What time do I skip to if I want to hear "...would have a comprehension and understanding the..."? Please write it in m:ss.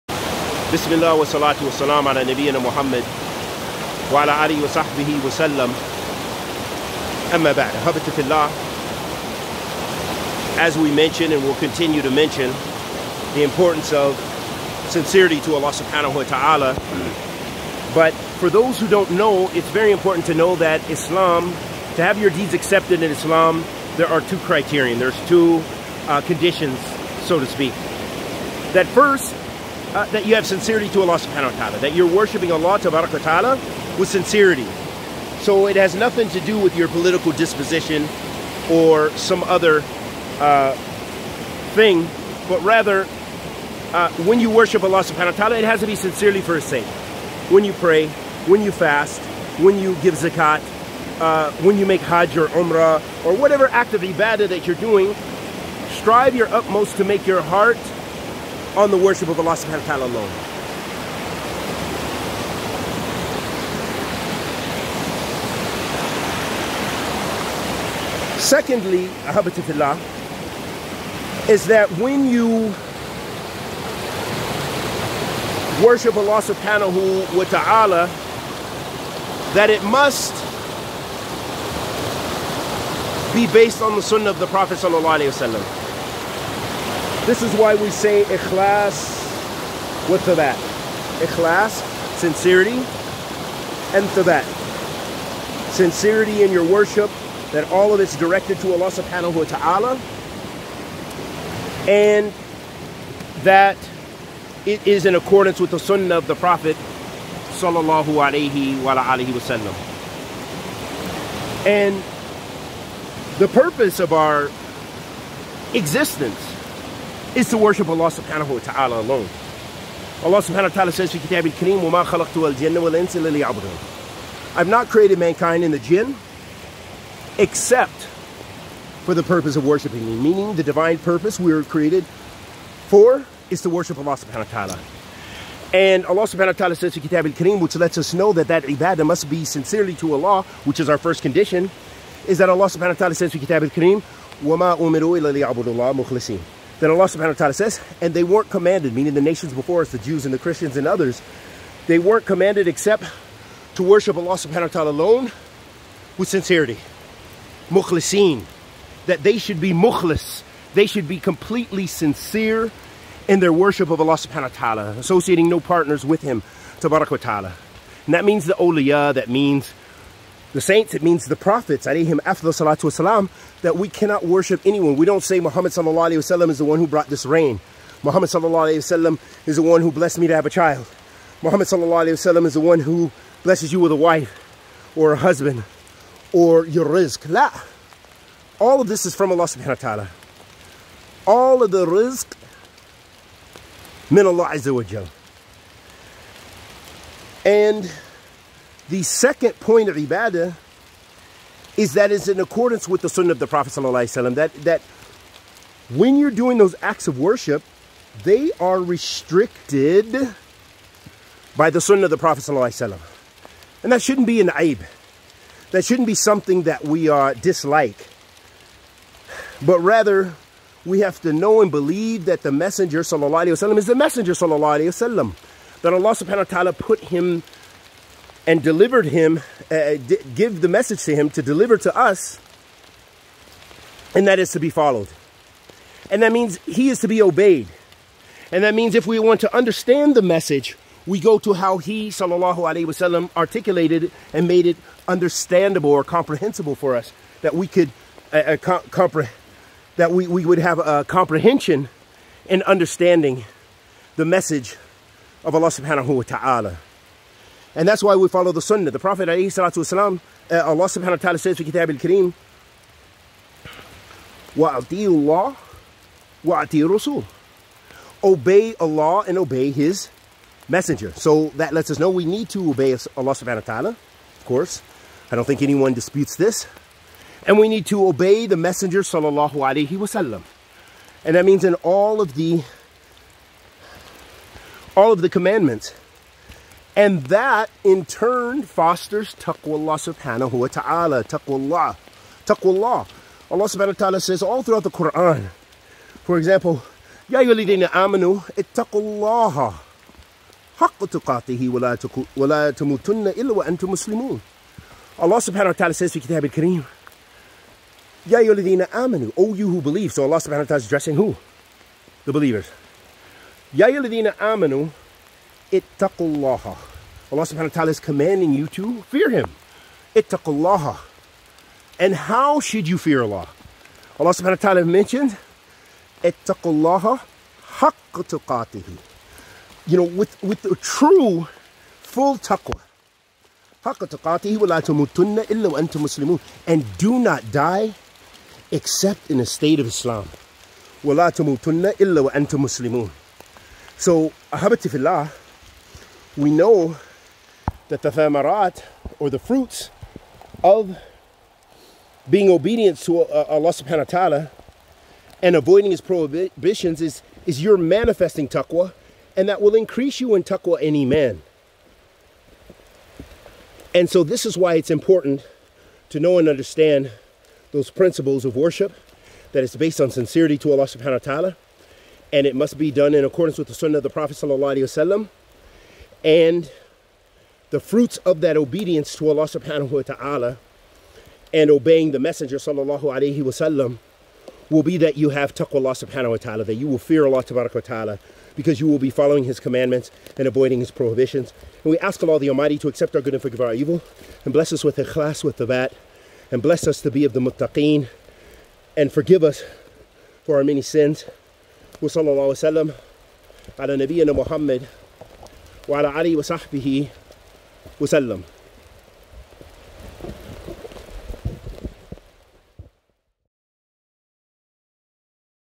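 4:10.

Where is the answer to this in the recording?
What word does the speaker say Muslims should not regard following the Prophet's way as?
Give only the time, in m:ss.
3:34.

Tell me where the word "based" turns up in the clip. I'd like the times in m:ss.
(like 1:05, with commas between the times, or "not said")
1:23, 6:09.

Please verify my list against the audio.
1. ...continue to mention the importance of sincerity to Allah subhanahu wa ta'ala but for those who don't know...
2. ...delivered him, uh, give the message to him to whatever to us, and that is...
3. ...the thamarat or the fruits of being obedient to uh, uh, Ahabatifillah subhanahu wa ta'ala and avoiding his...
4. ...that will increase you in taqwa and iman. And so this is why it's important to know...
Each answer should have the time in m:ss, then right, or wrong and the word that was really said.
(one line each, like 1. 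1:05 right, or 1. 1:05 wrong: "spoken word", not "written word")
1. 0:11 right
2. 3:48 wrong: "deliver", not "whatever"
3. 5:48 wrong: "Allah", not "Ahabatifillah"
4. 5:59 right.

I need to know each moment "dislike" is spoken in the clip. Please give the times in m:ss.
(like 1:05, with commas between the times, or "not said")
3:37.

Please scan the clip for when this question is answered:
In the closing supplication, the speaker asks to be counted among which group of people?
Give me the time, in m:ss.
6:37.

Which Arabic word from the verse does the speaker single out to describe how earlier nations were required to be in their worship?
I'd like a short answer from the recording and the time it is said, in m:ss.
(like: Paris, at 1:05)
Mukhlisin, at 2:37.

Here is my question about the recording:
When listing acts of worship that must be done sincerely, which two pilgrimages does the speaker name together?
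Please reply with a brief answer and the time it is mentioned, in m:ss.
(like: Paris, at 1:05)
hajj or umrah, at 0:52.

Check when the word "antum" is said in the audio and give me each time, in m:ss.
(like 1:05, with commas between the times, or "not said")
5:03, 5:35, 5:42.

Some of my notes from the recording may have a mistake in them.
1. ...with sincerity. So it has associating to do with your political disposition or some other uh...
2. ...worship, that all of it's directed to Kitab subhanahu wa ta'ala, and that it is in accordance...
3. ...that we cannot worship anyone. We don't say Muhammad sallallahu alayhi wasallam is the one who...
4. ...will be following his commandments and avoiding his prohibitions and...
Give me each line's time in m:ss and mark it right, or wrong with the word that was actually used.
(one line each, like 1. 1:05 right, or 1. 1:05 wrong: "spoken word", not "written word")
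1. 0:33 wrong: "nothing", not "associating"
2. 1:36 wrong: "Allah", not "Kitab"
3. 2:53 right
4. 6:28 right.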